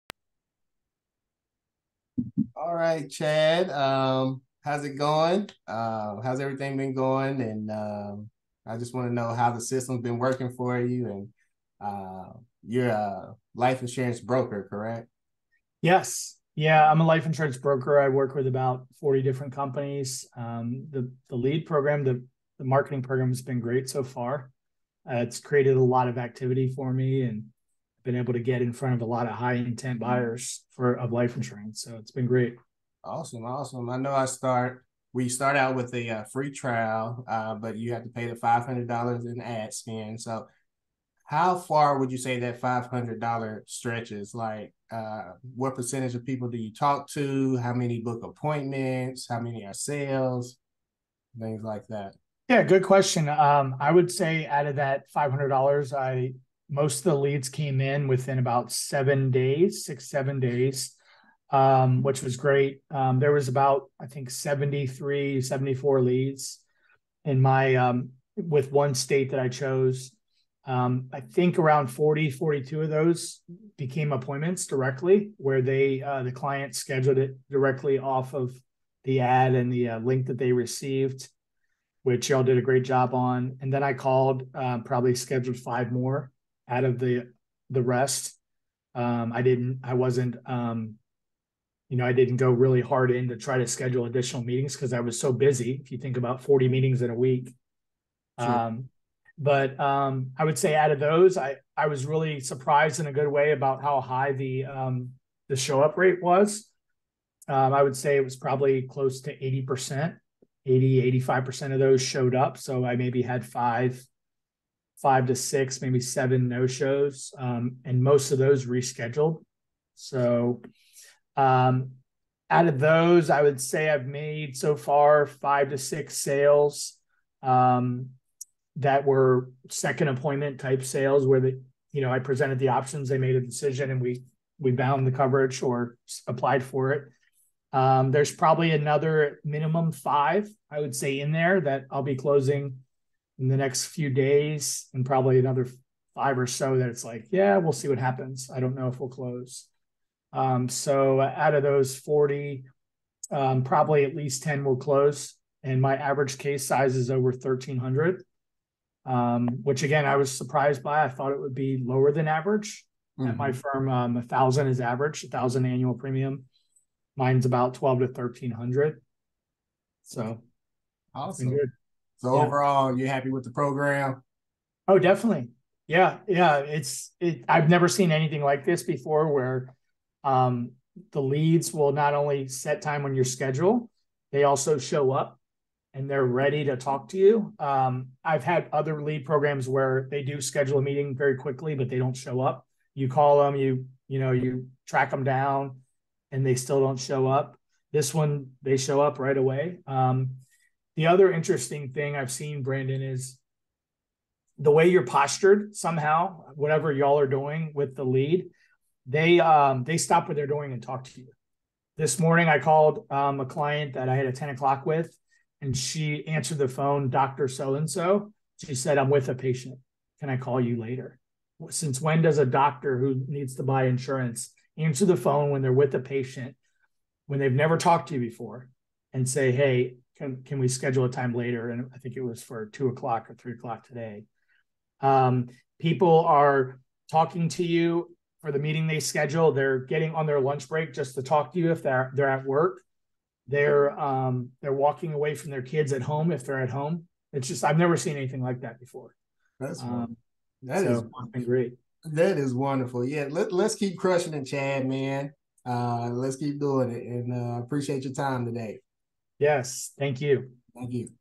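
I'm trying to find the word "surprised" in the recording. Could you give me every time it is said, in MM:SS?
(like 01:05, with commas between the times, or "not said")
01:42, 02:40.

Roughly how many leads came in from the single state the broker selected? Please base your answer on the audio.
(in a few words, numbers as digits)
73 or 74.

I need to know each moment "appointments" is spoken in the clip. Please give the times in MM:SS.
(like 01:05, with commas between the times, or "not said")
00:48, 01:14, 02:10.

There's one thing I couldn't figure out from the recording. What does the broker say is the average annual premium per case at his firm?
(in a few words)
$1,000.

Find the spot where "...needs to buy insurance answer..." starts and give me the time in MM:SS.
03:43.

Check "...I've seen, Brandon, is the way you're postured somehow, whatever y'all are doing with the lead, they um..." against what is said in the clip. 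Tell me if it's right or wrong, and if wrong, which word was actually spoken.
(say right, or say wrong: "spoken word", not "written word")
right.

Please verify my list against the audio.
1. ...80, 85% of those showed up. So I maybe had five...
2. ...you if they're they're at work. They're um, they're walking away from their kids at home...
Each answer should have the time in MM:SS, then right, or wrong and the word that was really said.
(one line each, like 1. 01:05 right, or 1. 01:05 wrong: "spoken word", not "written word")
1. 01:50 right
2. 04:01 right.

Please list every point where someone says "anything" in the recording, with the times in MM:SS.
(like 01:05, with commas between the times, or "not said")
02:58, 04:08.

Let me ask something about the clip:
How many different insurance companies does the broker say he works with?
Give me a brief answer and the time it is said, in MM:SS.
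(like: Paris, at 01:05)
40, at 00:18.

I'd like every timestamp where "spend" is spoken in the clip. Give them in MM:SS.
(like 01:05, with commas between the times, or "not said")
00:39.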